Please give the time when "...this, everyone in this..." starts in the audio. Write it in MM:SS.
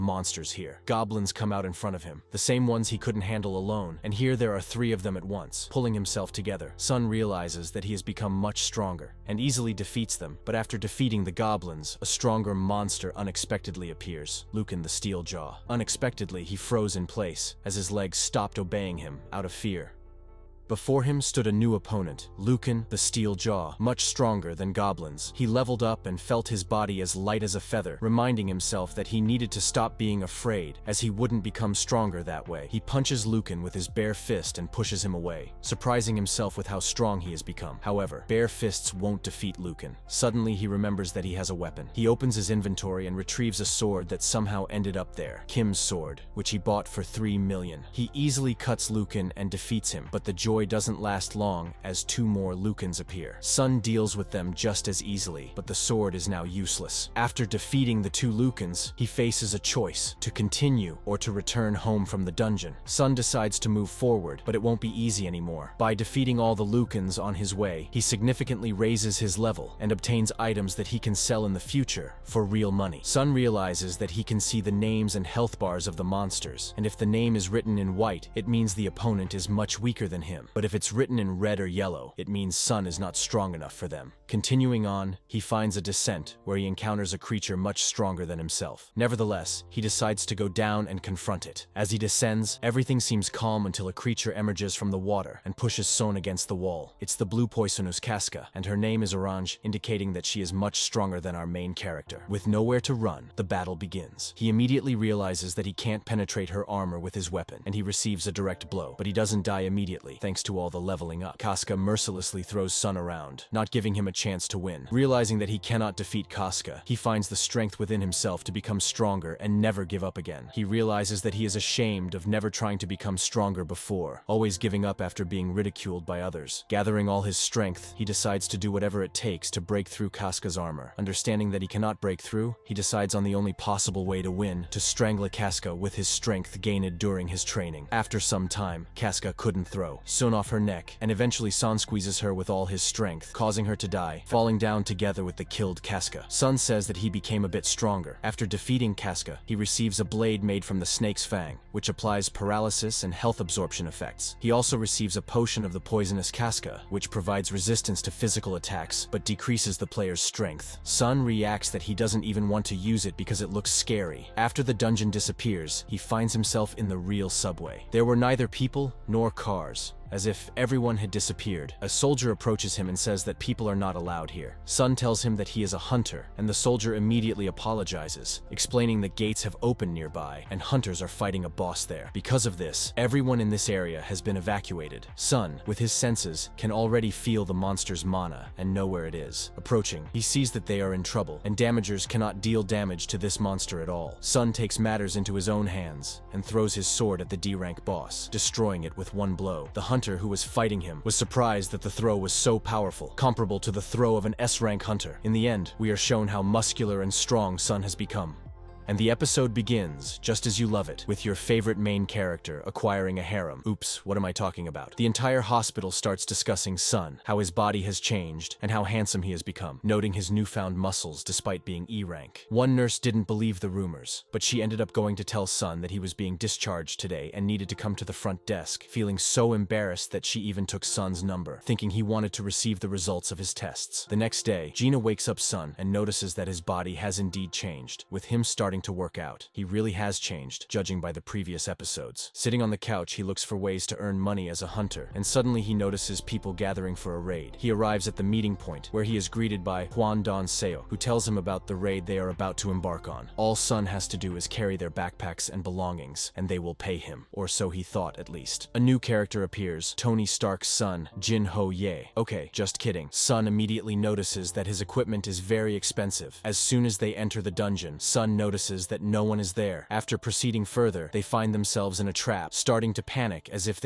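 03:02.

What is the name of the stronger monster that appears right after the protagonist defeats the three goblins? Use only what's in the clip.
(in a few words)
Lucan the Steeljaw.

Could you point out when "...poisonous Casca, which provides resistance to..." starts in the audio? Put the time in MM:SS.
02:35.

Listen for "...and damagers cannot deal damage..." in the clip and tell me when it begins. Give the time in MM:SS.
03:11.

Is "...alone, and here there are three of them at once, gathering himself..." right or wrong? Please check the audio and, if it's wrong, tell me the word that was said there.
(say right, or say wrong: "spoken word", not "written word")
wrong: "pulling", not "gathering".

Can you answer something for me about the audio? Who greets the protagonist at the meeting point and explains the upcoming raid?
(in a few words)
Juan Don Seo.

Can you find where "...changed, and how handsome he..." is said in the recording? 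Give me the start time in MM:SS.
03:37.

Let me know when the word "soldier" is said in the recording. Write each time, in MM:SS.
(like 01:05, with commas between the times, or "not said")
02:51, 02:56.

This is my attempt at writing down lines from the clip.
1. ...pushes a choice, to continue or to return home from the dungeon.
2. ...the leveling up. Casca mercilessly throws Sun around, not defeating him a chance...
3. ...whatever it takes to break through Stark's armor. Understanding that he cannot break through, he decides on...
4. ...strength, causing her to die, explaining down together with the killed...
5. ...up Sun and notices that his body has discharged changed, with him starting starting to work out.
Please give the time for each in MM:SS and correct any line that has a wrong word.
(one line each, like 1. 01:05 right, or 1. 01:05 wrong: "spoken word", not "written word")
1. 00:59 wrong: "faces", not "pushes"
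2. 01:50 wrong: "giving", not "defeating"
3. 02:08 wrong: "Casca", not "Stark"
4. 02:22 wrong: "falling", not "explaining"
5. 03:55 wrong: "indeed", not "discharged".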